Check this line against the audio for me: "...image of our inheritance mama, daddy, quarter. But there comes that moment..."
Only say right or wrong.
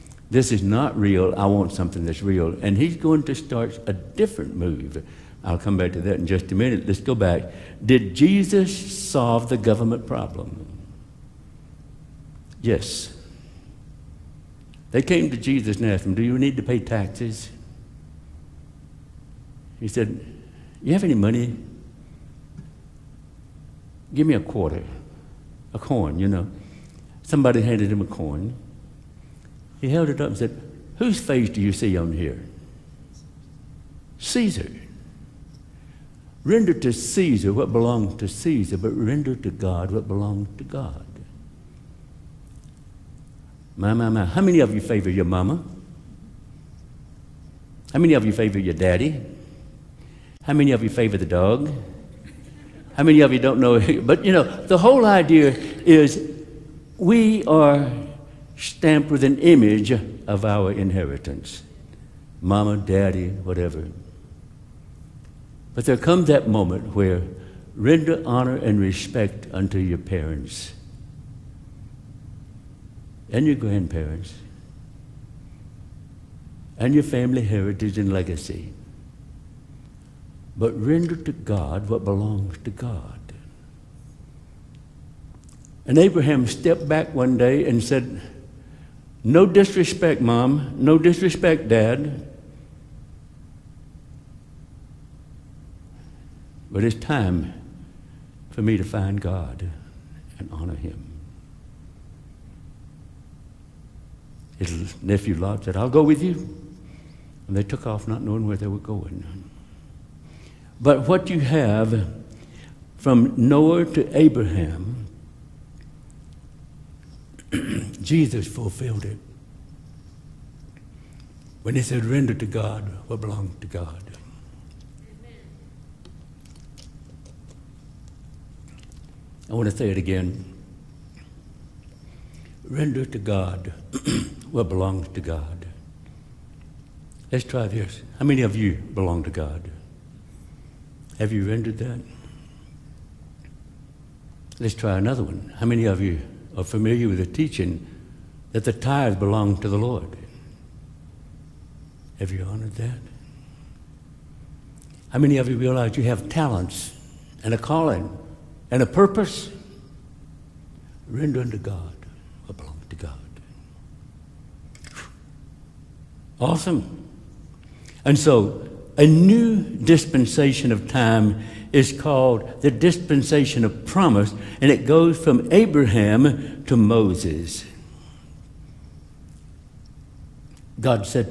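wrong.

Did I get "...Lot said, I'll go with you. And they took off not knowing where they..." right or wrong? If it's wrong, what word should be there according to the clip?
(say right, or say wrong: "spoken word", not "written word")
right.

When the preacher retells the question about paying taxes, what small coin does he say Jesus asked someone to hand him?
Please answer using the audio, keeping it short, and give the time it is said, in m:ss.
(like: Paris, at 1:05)
a quarter, at 0:24.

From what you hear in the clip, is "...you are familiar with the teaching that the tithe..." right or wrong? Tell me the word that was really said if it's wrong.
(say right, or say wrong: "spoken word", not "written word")
right.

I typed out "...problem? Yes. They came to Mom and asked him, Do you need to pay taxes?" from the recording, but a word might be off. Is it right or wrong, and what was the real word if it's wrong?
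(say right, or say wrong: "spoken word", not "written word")
wrong: "Jesus", not "Mom".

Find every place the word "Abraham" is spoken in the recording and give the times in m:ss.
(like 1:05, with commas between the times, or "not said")
1:25, 1:54, 2:55.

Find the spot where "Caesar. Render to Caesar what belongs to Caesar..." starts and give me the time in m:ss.
0:34.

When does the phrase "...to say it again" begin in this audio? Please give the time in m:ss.
2:09.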